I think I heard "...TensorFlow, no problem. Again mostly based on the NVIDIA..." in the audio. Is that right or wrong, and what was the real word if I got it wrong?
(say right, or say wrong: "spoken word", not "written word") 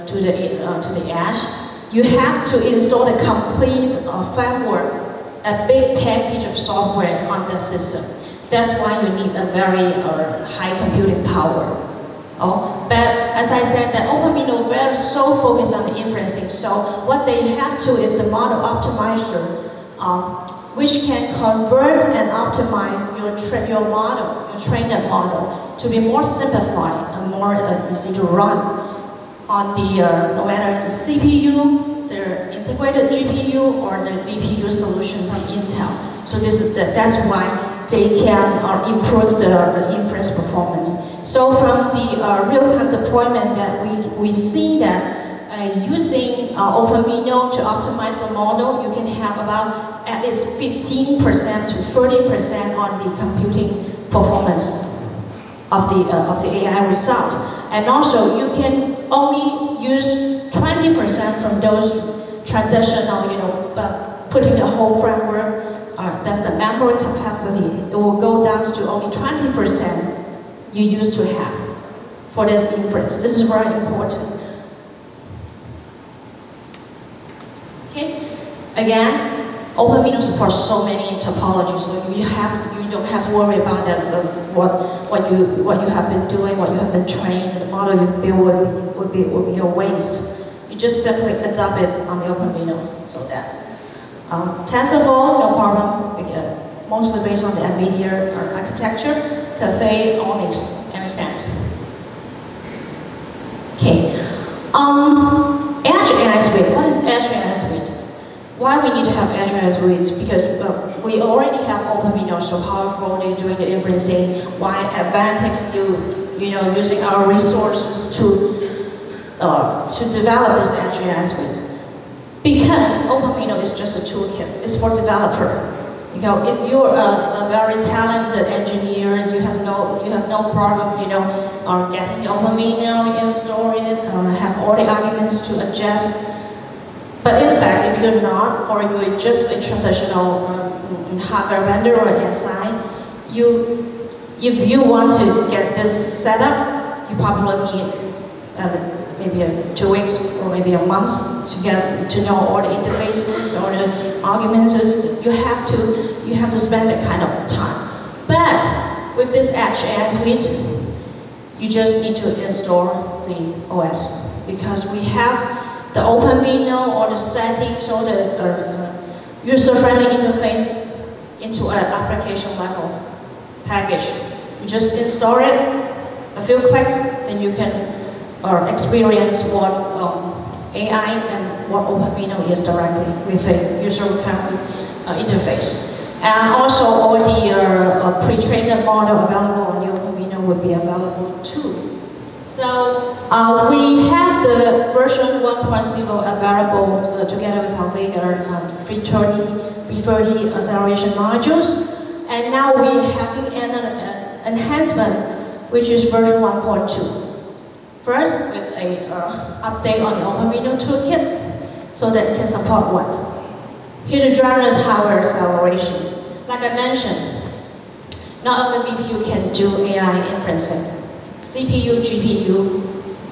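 right.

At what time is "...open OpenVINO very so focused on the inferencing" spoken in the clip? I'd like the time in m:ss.
0:14.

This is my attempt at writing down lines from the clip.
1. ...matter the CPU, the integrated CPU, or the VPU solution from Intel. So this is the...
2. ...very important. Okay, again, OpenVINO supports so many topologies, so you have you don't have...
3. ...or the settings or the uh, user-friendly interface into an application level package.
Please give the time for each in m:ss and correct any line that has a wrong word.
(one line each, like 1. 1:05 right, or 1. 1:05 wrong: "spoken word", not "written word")
1. 0:30 wrong: "GPU", not "CPU"
2. 1:13 right
3. 2:46 right.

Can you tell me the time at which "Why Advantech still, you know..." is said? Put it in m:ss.
1:54.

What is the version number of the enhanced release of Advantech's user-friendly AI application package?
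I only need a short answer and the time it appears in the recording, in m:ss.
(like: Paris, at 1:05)
1.2, at 3:26.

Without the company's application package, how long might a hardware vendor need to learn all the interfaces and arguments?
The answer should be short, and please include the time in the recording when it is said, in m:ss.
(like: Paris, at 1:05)
two weeks, at 2:29.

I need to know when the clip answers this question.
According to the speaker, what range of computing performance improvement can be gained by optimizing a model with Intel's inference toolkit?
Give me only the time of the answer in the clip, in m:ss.
0:50.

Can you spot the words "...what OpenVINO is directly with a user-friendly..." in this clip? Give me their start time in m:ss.
3:01.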